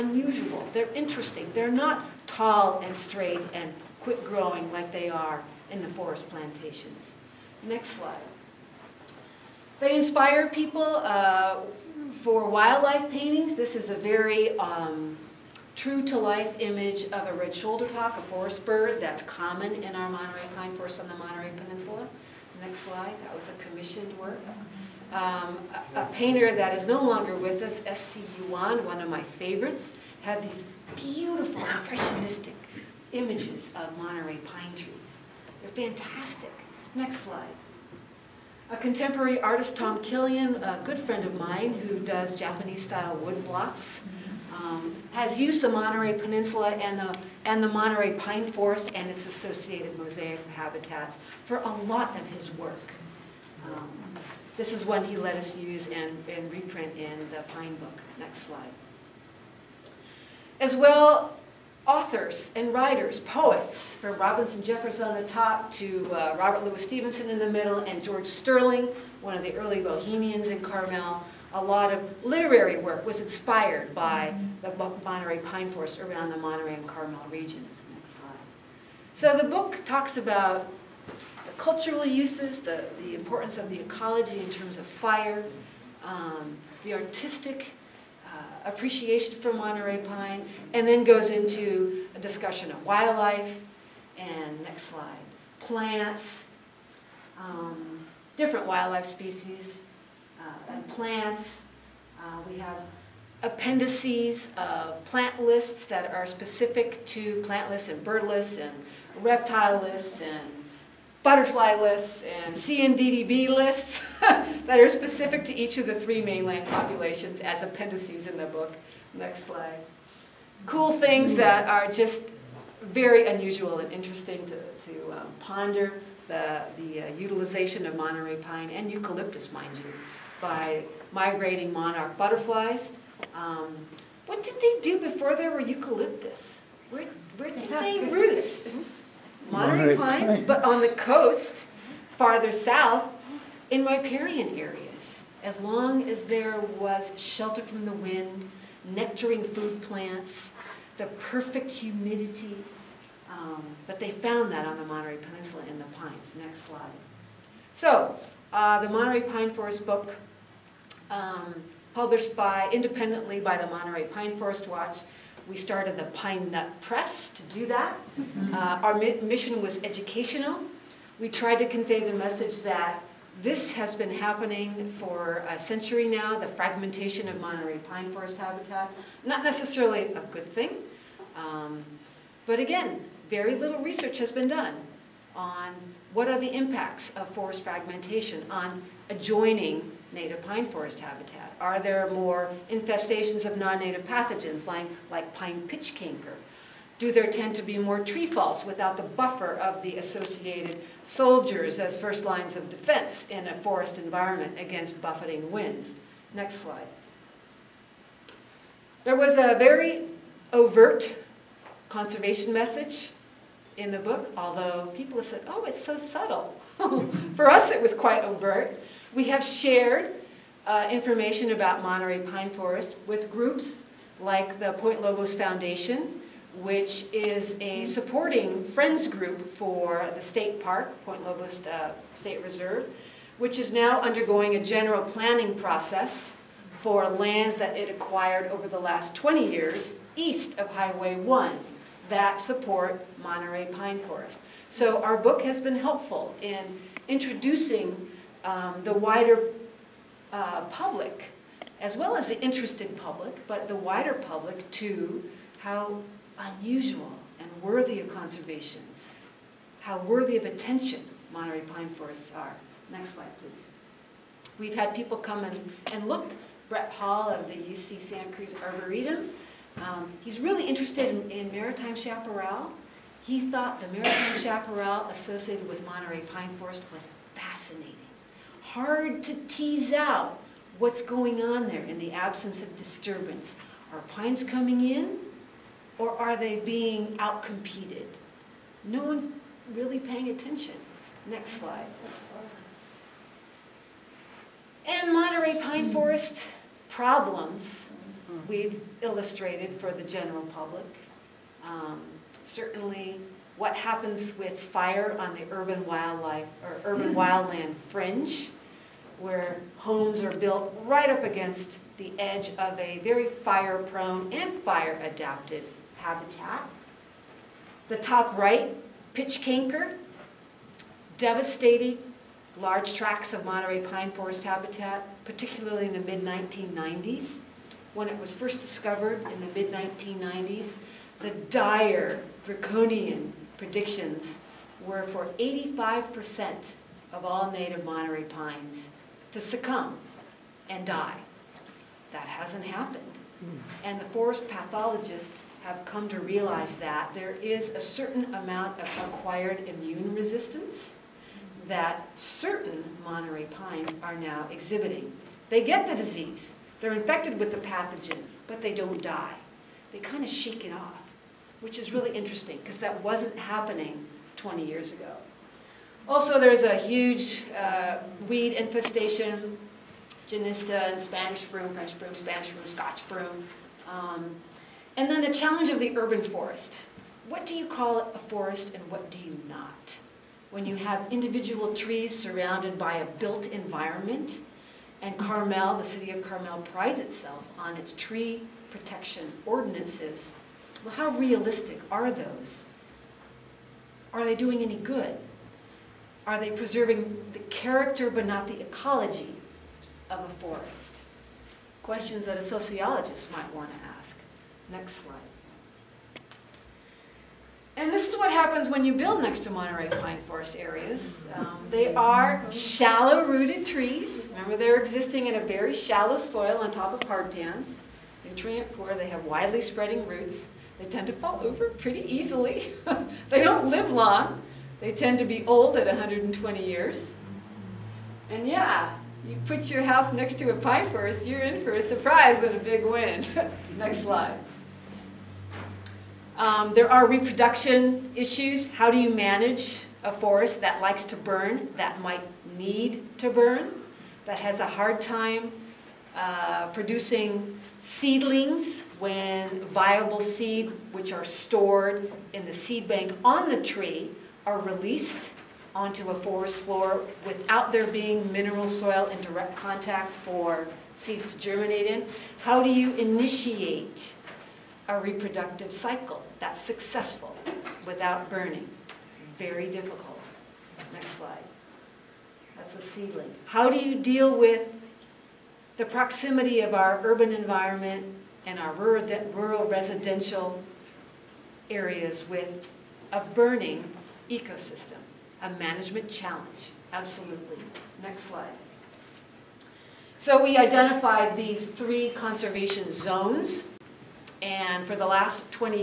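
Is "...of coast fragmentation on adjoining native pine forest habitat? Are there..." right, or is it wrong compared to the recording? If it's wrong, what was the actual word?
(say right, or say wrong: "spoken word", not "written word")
wrong: "forest", not "coast".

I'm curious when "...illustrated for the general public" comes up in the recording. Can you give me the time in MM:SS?
04:59.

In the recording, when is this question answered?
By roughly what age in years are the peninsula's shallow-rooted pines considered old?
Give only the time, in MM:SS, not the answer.
07:05.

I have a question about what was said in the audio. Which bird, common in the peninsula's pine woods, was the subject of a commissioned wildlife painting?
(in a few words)
red-shouldered hawk.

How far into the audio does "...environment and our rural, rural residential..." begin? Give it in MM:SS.
07:57.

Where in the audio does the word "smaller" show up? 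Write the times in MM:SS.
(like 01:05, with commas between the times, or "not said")
not said.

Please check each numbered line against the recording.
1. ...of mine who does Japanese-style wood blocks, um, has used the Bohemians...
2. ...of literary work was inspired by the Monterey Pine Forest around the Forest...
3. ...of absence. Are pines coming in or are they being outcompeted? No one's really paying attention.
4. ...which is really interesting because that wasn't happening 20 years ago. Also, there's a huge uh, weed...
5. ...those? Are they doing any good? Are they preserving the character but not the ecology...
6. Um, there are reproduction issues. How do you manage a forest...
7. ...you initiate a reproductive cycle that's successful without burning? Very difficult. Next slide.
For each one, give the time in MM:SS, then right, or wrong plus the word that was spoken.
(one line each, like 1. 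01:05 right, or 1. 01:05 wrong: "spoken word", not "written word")
1. 00:41 wrong: "Monterey", not "Bohemians"
2. 01:11 wrong: "Monterey", not "Forest"
3. 04:42 wrong: "disturbance", not "absence"
4. 06:01 right
5. 06:32 right
6. 07:16 right
7. 07:42 right.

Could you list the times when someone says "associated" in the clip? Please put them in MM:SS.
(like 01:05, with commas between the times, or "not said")
00:49, 03:19, 04:35.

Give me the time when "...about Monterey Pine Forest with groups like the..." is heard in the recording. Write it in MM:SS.
03:41.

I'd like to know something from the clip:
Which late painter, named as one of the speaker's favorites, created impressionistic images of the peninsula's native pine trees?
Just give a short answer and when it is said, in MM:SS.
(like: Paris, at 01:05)
S.C. Yuan, at 00:27.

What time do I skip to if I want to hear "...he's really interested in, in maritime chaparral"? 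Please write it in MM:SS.
04:30.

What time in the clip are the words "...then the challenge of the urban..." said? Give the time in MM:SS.
06:15.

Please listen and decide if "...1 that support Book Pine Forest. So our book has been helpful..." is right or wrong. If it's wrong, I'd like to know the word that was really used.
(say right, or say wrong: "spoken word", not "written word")
wrong: "Monterey", not "Book".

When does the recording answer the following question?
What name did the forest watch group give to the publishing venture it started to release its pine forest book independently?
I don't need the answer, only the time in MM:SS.
02:46.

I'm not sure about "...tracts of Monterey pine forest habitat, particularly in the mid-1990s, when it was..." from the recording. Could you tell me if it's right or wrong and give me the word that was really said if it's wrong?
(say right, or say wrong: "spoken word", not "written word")
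right.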